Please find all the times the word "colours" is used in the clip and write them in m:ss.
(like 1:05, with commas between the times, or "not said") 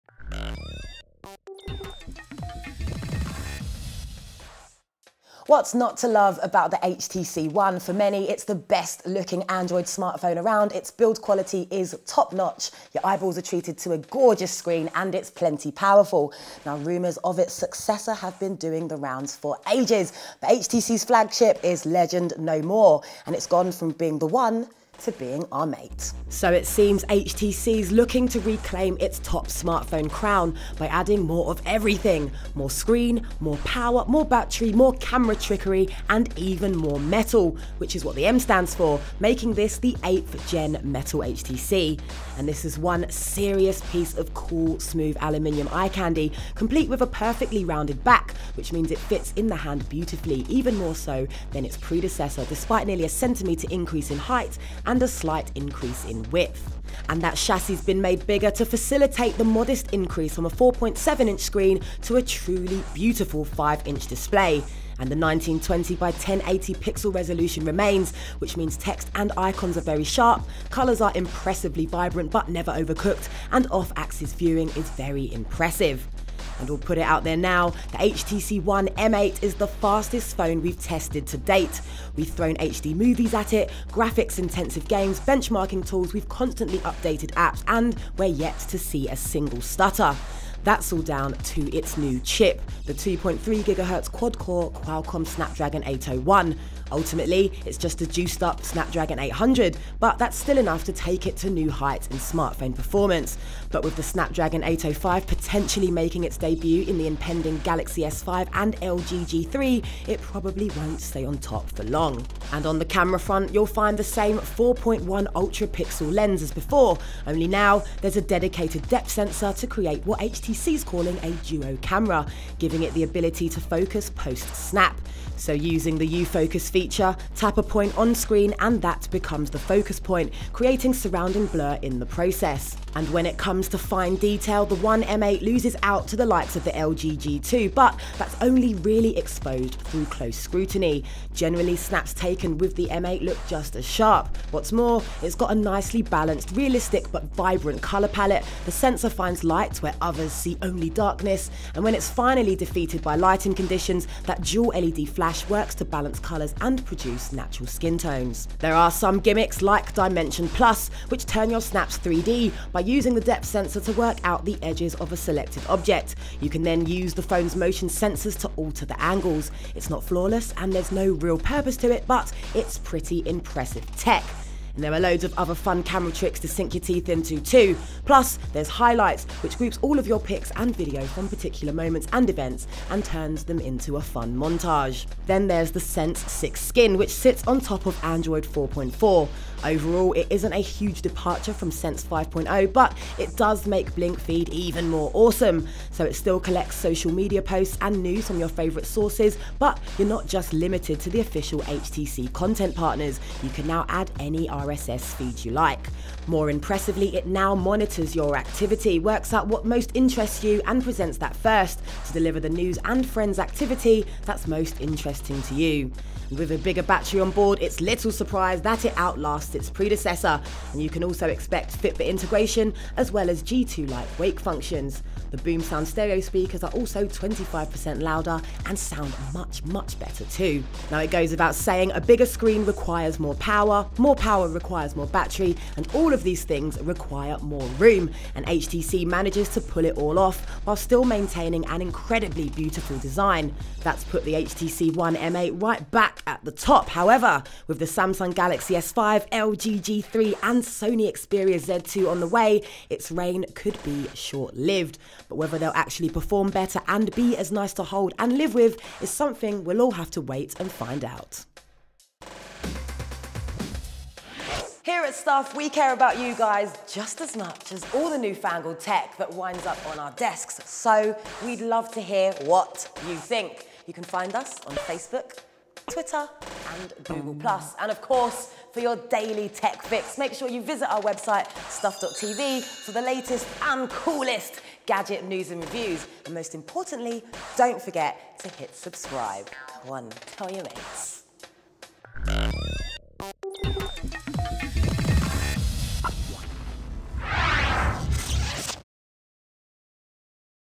1:10, 2:27, 2:36.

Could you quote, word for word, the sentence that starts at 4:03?
That's put the HTC One M8 right back at the top.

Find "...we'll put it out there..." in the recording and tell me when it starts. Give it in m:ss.
1:16.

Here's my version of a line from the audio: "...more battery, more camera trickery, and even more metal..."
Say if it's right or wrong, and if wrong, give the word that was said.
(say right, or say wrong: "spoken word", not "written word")
right.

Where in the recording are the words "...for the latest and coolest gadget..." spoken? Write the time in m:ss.
4:42.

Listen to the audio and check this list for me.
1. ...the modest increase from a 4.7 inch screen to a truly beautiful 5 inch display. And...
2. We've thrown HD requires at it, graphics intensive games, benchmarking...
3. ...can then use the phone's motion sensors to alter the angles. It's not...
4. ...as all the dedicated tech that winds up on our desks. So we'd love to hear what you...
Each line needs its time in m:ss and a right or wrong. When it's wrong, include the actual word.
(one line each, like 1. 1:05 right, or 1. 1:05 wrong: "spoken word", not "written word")
1. 0:59 right
2. 1:22 wrong: "movies", not "requires"
3. 2:46 right
4. 4:27 wrong: "newfangled", not "dedicated".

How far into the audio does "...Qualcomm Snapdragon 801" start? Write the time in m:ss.
1:34.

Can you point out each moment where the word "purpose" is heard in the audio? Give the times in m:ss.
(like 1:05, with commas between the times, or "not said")
2:51.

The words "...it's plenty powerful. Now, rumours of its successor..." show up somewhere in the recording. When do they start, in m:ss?
0:15.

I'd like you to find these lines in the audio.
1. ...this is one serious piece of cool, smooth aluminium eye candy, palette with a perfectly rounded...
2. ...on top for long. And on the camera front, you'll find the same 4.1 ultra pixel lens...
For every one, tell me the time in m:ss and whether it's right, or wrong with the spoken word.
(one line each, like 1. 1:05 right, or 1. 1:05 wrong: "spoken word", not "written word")
1. 0:42 wrong: "complete", not "palette"
2. 1:51 right.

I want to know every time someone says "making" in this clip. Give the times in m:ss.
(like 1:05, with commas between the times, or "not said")
0:39, 1:45.